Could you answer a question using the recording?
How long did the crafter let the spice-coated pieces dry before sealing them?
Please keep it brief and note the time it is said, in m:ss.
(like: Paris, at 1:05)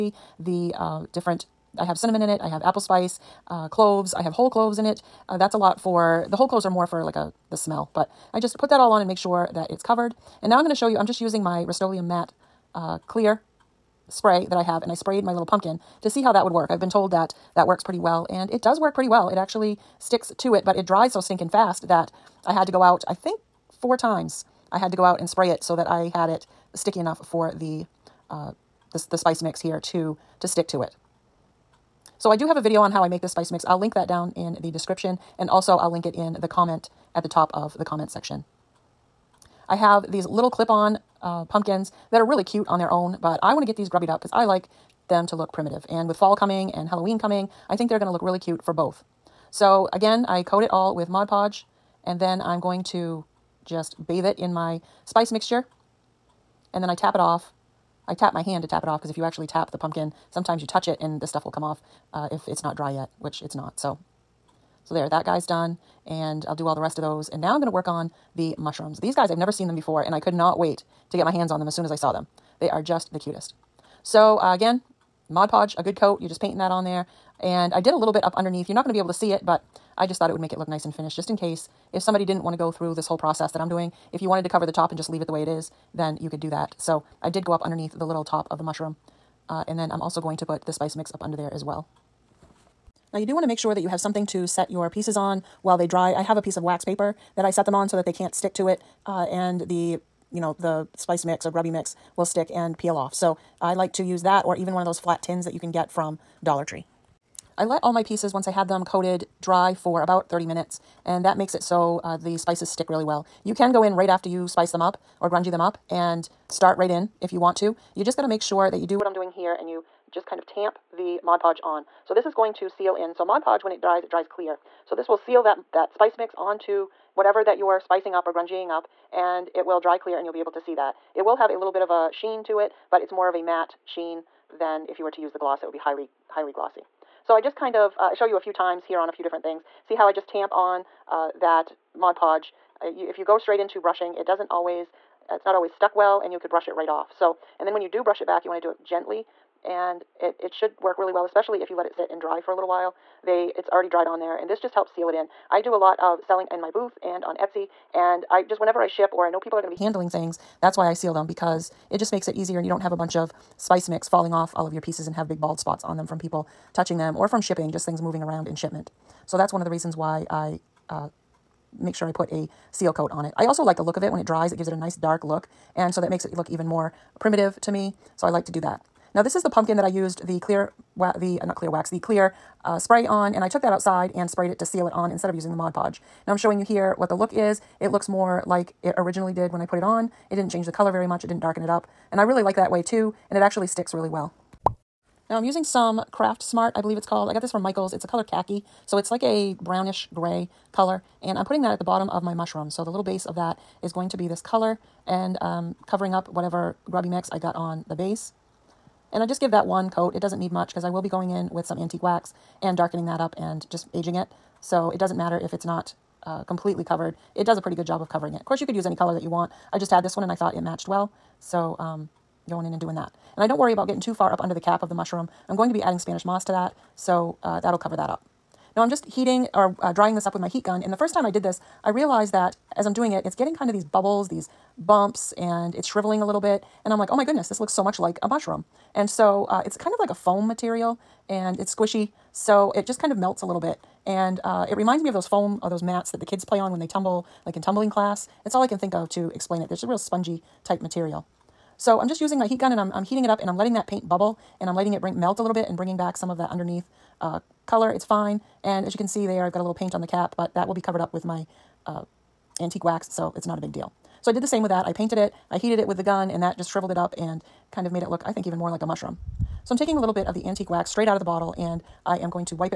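30 minutes, at 1:50.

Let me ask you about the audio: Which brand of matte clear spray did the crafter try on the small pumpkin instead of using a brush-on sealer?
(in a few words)
Rust-Oleum.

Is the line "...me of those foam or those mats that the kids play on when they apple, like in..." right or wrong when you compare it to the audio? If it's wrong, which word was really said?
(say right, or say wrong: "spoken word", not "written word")
wrong: "tumble", not "apple".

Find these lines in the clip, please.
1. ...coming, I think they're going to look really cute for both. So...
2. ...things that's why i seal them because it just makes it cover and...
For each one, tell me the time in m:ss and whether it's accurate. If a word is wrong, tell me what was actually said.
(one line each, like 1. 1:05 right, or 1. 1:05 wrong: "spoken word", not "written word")
1. 0:47 right
2. 2:40 wrong: "easier", not "cover".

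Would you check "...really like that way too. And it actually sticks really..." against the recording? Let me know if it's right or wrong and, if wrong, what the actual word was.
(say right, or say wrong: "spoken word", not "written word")
right.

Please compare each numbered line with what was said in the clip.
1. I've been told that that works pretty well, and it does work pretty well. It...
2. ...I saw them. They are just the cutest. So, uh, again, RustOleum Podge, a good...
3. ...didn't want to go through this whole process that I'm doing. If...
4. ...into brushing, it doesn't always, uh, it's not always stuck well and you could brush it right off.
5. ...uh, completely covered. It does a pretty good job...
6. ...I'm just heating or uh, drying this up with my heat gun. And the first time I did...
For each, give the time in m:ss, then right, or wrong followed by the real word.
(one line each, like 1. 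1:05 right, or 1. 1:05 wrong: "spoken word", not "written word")
1. 0:16 right
2. 1:11 wrong: "Mod", not "RustOleum"
3. 1:22 right
4. 2:23 right
5. 3:36 right
6. 3:48 right.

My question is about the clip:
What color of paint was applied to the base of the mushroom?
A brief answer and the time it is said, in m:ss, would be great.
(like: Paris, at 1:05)
khaki, at 3:18.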